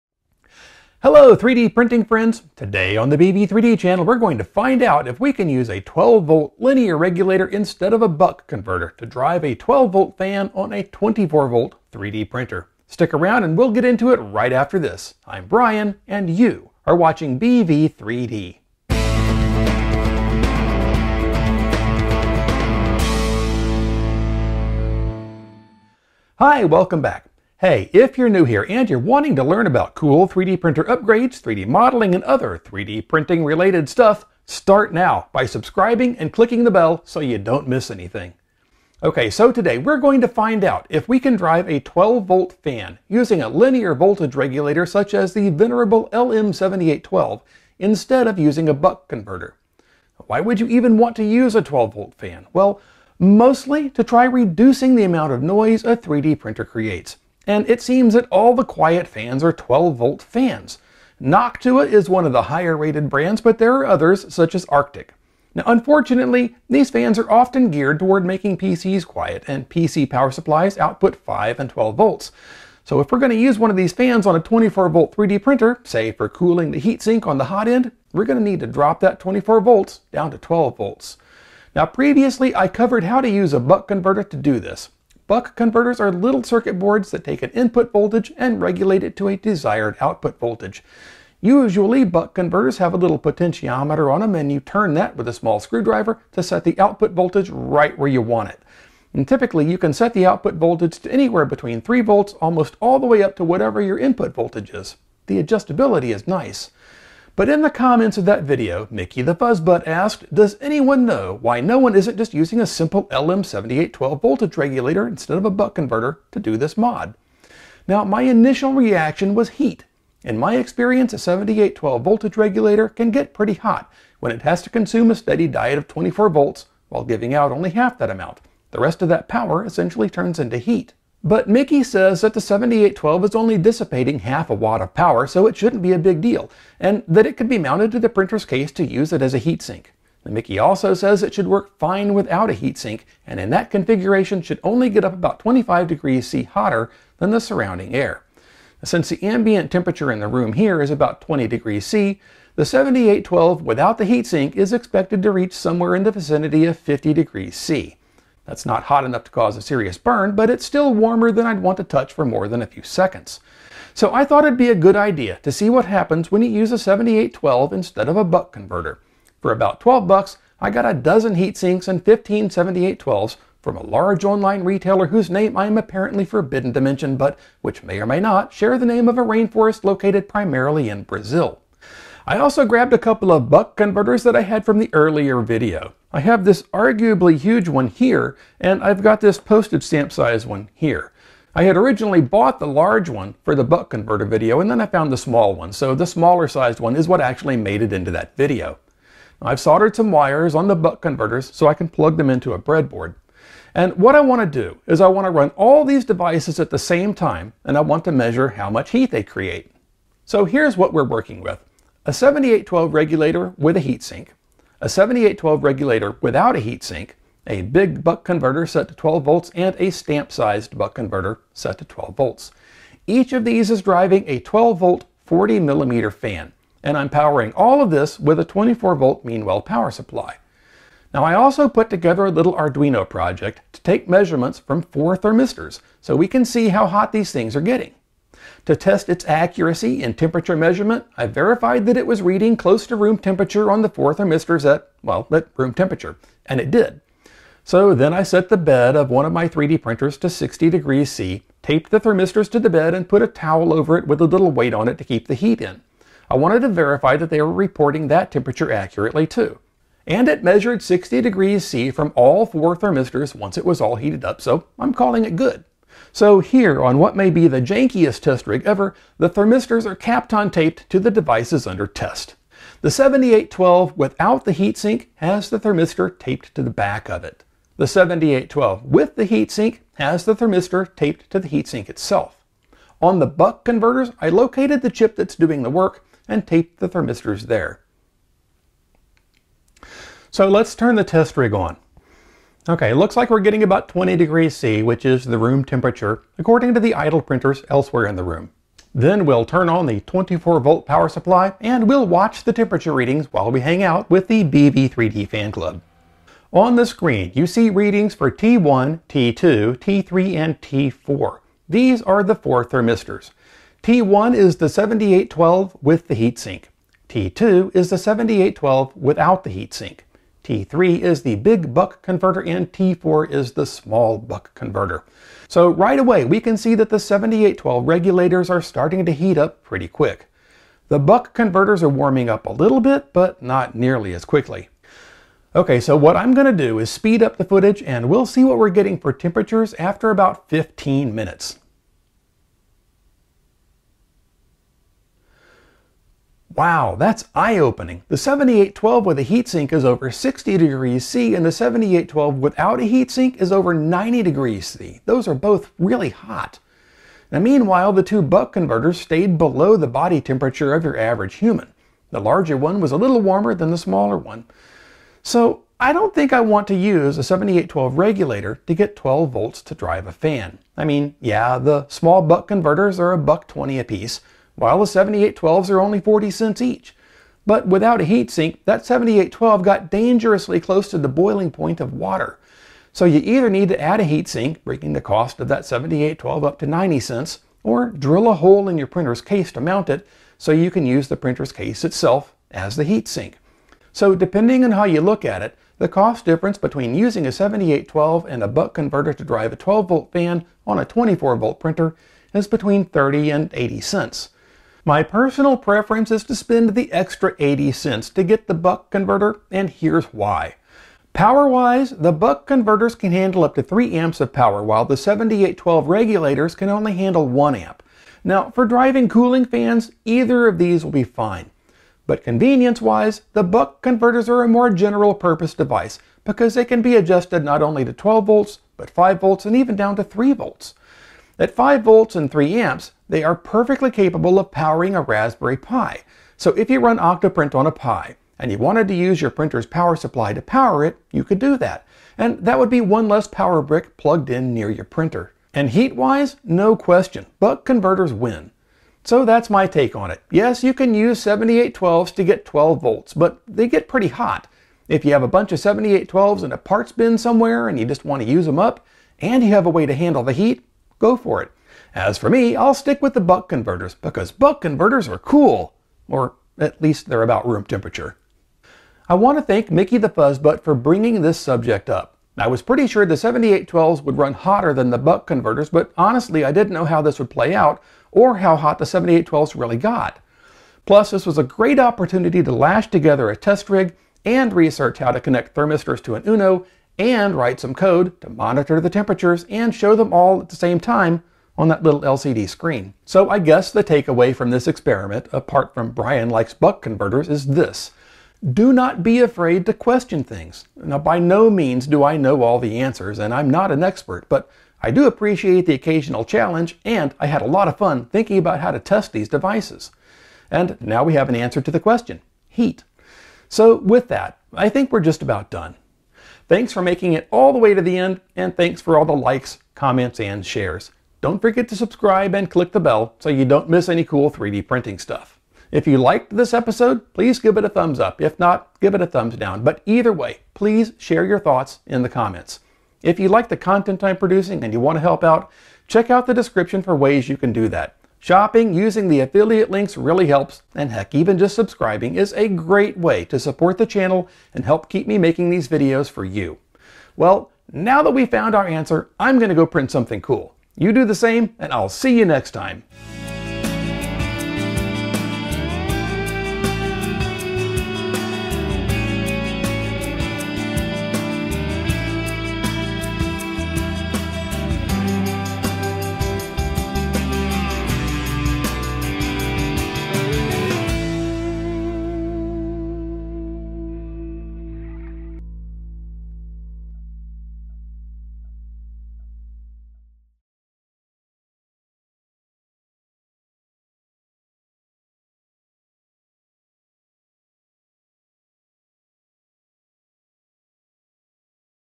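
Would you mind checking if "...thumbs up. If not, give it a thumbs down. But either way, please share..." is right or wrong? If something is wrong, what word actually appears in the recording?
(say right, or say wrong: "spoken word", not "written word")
right.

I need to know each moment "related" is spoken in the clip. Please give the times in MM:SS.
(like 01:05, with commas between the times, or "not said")
00:33.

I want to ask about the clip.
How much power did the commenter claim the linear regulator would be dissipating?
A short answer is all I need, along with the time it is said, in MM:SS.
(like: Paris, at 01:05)
half a watt, at 02:14.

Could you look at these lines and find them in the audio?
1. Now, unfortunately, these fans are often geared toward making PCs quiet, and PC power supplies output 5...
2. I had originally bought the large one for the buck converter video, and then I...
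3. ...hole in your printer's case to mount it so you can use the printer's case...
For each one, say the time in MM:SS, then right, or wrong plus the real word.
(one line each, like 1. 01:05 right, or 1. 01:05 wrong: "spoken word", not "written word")
1. 01:05 right
2. 03:11 right
3. 06:28 right.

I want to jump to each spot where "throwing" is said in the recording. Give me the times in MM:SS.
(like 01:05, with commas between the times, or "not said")
not said.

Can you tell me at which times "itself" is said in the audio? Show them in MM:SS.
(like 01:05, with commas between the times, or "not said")
04:41, 06:31.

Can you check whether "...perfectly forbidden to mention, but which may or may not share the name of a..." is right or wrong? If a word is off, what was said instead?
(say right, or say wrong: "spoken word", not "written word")
wrong: "apparently", not "perfectly".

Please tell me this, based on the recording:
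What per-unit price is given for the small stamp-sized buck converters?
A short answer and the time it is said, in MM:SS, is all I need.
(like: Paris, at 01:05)
$1.20, at 06:13.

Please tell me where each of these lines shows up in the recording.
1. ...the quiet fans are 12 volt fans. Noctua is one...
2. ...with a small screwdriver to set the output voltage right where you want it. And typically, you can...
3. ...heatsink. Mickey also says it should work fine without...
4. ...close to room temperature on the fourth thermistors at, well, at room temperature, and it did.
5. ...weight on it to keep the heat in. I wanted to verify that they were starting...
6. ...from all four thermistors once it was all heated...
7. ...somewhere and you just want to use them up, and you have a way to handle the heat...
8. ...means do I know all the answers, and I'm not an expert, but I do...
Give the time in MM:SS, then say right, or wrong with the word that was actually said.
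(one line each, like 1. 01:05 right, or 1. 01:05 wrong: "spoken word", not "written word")
1. 00:58 right
2. 01:35 right
3. 02:19 right
4. 04:02 right
5. 04:14 wrong: "reporting", not "starting"
6. 04:21 right
7. 07:37 right
8. 08:21 right.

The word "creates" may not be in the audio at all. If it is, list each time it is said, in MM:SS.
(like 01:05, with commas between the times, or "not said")
00:56, 03:29.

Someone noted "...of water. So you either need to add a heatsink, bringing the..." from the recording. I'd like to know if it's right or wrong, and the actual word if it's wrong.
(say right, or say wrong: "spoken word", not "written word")
right.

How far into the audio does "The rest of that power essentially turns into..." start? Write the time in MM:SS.
02:08.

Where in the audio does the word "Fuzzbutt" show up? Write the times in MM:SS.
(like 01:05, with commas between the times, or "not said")
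01:49, 07:50.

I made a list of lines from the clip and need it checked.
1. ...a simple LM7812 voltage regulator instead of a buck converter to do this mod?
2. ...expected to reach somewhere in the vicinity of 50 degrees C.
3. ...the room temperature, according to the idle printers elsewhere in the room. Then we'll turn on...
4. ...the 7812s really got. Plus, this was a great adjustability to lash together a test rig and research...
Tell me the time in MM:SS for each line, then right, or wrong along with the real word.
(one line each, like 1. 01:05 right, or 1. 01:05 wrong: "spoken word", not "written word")
1. 01:52 right
2. 02:34 right
3. 04:55 right
4. 07:58 wrong: "opportunity", not "adjustability".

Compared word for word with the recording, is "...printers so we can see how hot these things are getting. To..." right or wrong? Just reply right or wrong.
wrong.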